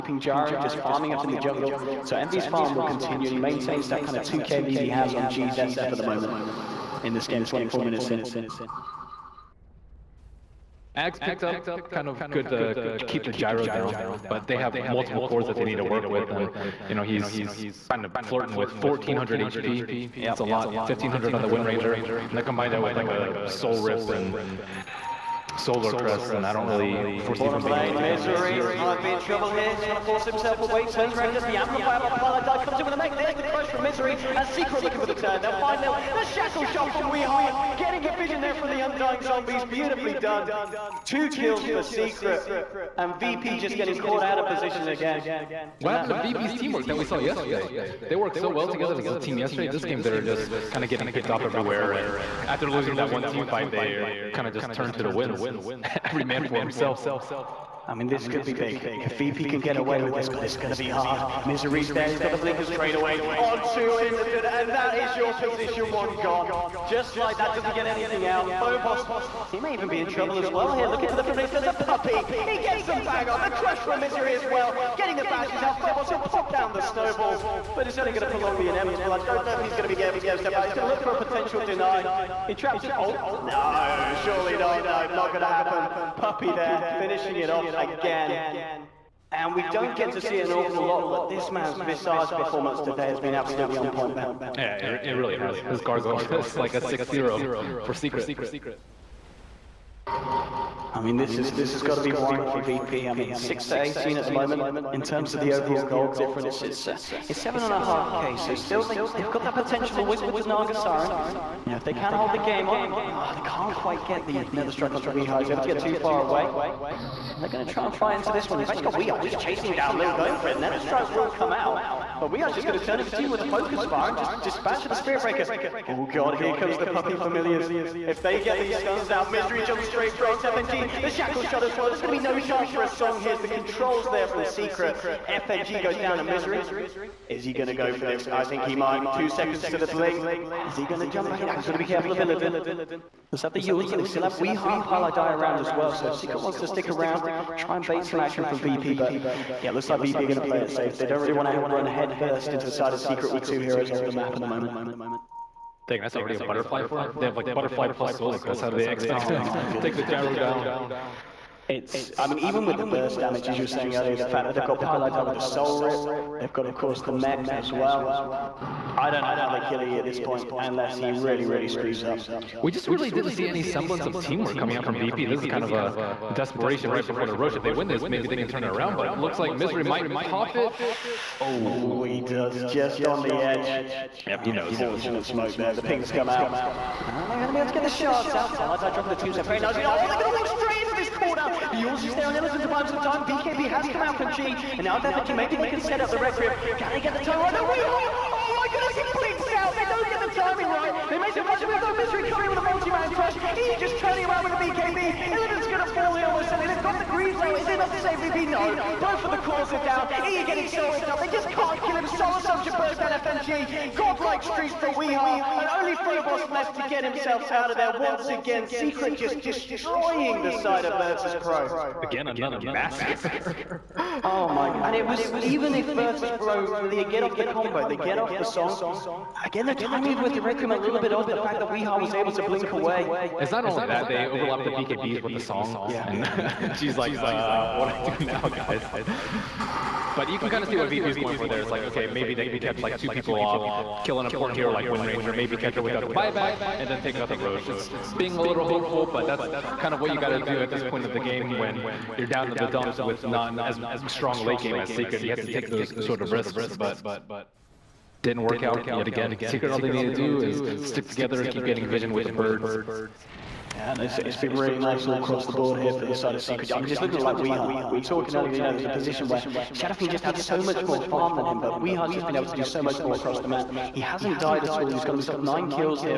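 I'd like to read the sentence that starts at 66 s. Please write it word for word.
Just like that, doesn't get anything out.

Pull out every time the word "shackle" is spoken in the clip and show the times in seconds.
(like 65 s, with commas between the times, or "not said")
36 s, 131 s.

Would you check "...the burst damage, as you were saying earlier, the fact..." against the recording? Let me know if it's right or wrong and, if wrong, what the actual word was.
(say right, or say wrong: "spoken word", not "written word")
right.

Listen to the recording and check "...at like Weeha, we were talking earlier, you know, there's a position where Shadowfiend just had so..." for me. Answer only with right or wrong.
right.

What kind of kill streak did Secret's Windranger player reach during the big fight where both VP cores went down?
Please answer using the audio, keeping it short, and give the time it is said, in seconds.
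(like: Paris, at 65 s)
Godlike, at 213 s.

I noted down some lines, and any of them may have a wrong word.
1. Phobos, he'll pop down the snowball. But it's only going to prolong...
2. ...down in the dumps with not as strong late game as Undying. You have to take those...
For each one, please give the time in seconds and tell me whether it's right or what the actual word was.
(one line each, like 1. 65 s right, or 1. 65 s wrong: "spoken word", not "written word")
1. 75 s right
2. 252 s wrong: "Secret", not "Undying".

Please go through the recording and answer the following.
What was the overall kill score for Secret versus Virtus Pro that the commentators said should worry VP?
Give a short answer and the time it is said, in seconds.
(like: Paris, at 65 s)
18 to 6, at 103 s.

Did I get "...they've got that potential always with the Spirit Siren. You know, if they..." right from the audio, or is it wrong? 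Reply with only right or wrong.
wrong.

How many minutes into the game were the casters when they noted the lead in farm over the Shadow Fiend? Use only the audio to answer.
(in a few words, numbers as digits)
24.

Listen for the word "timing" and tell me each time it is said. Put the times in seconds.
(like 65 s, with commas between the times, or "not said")
200 s, 229 s.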